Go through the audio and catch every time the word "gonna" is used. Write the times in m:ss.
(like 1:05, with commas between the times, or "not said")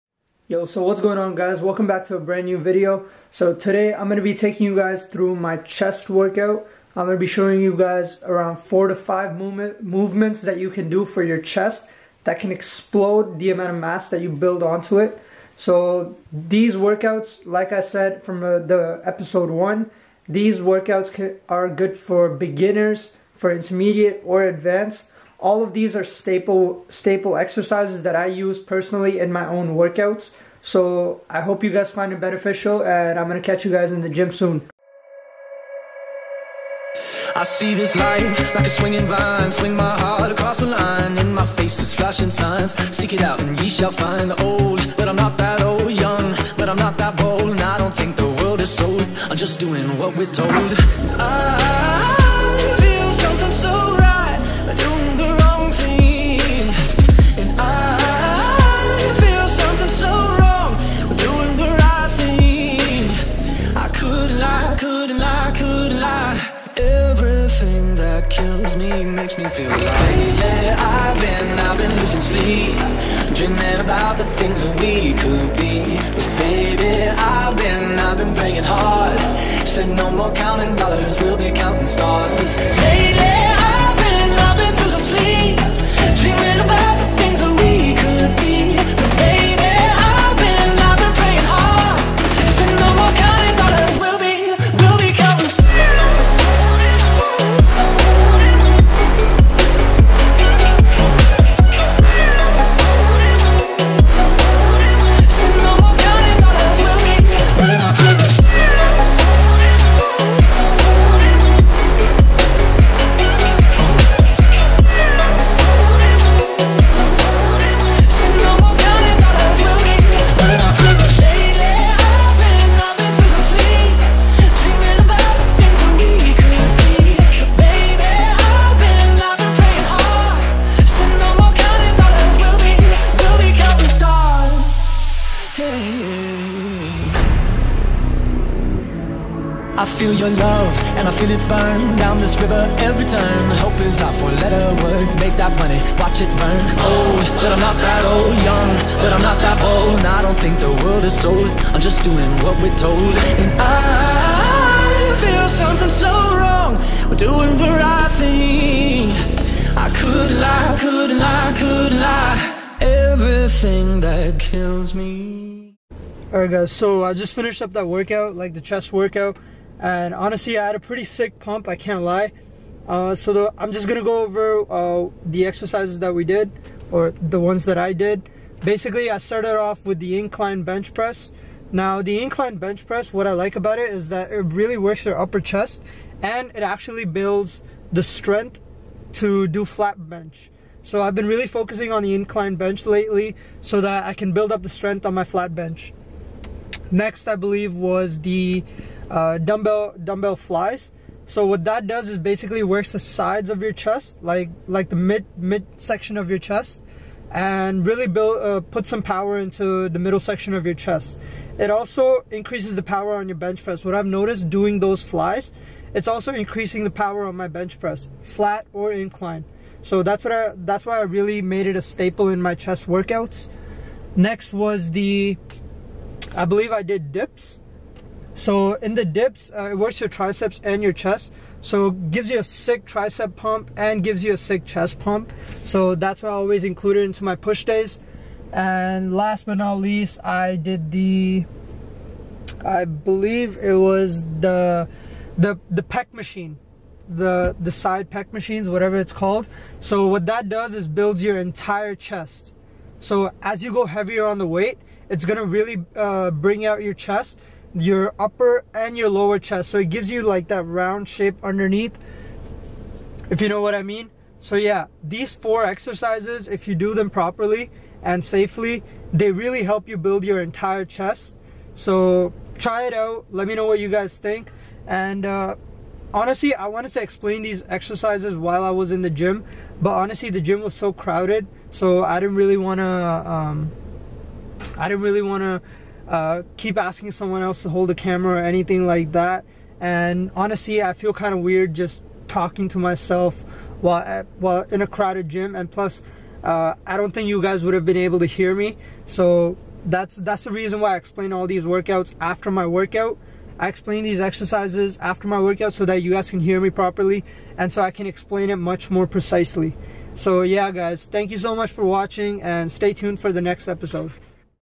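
0:33, 2:53, 4:15.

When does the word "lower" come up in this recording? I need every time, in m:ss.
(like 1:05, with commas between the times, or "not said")
4:19.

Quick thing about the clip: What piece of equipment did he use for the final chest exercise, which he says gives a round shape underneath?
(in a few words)
Pec machine.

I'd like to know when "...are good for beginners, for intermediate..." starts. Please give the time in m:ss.
0:21.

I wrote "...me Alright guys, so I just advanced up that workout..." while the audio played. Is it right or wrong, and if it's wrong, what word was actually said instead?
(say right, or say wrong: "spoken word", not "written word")
wrong: "finished", not "advanced".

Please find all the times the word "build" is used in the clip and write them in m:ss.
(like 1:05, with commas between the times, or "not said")
0:14, 3:07, 3:14, 3:28, 4:10, 4:29.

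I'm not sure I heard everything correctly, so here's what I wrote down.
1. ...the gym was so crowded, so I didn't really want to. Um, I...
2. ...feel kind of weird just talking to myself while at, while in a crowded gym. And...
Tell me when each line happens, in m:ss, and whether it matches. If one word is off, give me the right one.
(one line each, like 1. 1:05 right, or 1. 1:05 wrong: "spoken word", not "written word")
1. 4:40 right
2. 4:50 right.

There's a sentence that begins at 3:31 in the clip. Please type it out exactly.
It also increases the power on your bench press.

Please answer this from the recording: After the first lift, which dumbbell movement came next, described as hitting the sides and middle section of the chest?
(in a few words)
Dumbbell flies.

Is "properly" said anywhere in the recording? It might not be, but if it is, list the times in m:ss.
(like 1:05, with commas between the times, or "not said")
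4:27, 5:06.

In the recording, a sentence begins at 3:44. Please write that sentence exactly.
Next was the I believe I did dips.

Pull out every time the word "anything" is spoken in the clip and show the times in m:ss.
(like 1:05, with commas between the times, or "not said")
4:48.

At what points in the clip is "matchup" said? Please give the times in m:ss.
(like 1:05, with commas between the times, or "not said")
not said.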